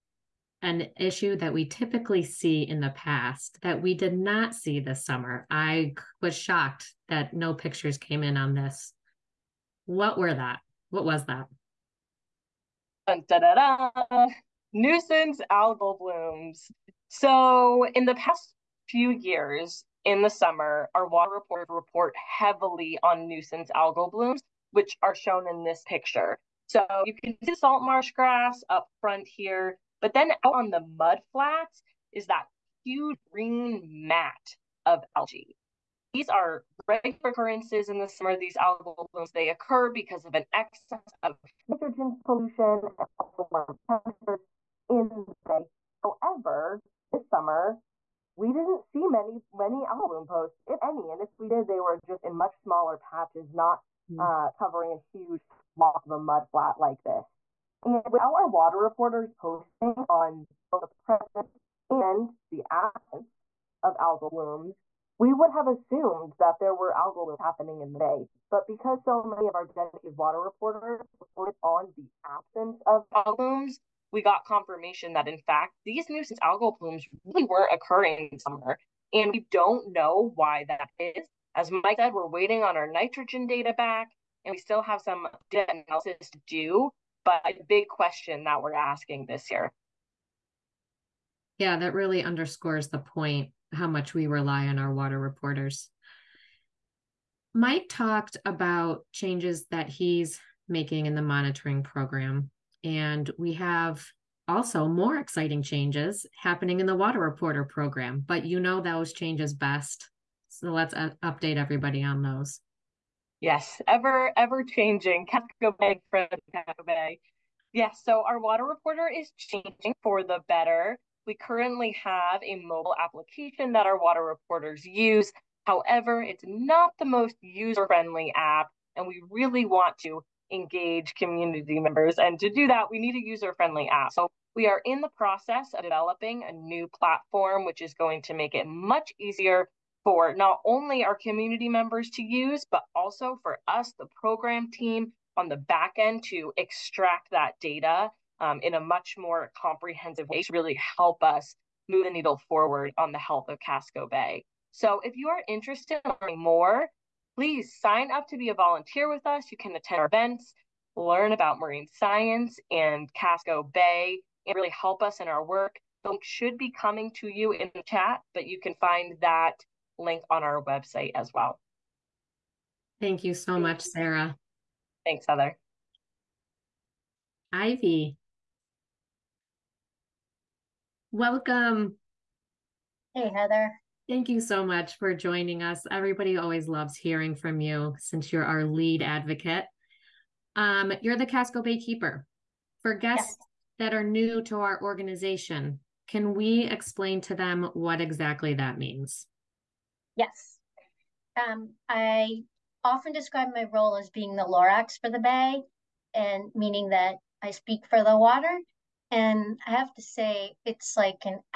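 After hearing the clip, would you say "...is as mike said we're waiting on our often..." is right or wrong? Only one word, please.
wrong.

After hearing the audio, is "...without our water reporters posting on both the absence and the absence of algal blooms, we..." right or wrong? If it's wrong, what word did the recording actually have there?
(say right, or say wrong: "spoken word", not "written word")
wrong: "presence", not "absence".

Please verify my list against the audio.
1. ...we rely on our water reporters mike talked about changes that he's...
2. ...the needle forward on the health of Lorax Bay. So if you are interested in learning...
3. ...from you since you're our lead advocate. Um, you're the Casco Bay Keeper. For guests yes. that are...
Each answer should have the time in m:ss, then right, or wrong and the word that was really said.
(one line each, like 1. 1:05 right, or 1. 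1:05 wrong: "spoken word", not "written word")
1. 1:34 right
2. 2:32 wrong: "Casco", not "Lorax"
3. 3:07 right.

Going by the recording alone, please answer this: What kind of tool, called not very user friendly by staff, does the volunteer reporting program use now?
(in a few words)
mobile application.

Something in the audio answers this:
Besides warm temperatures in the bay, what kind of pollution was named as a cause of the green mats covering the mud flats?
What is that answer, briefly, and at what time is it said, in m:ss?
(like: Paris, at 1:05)
nitrogen pollution, at 0:41.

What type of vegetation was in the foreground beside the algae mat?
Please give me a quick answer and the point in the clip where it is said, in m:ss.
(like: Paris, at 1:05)
salt marsh grass, at 0:27.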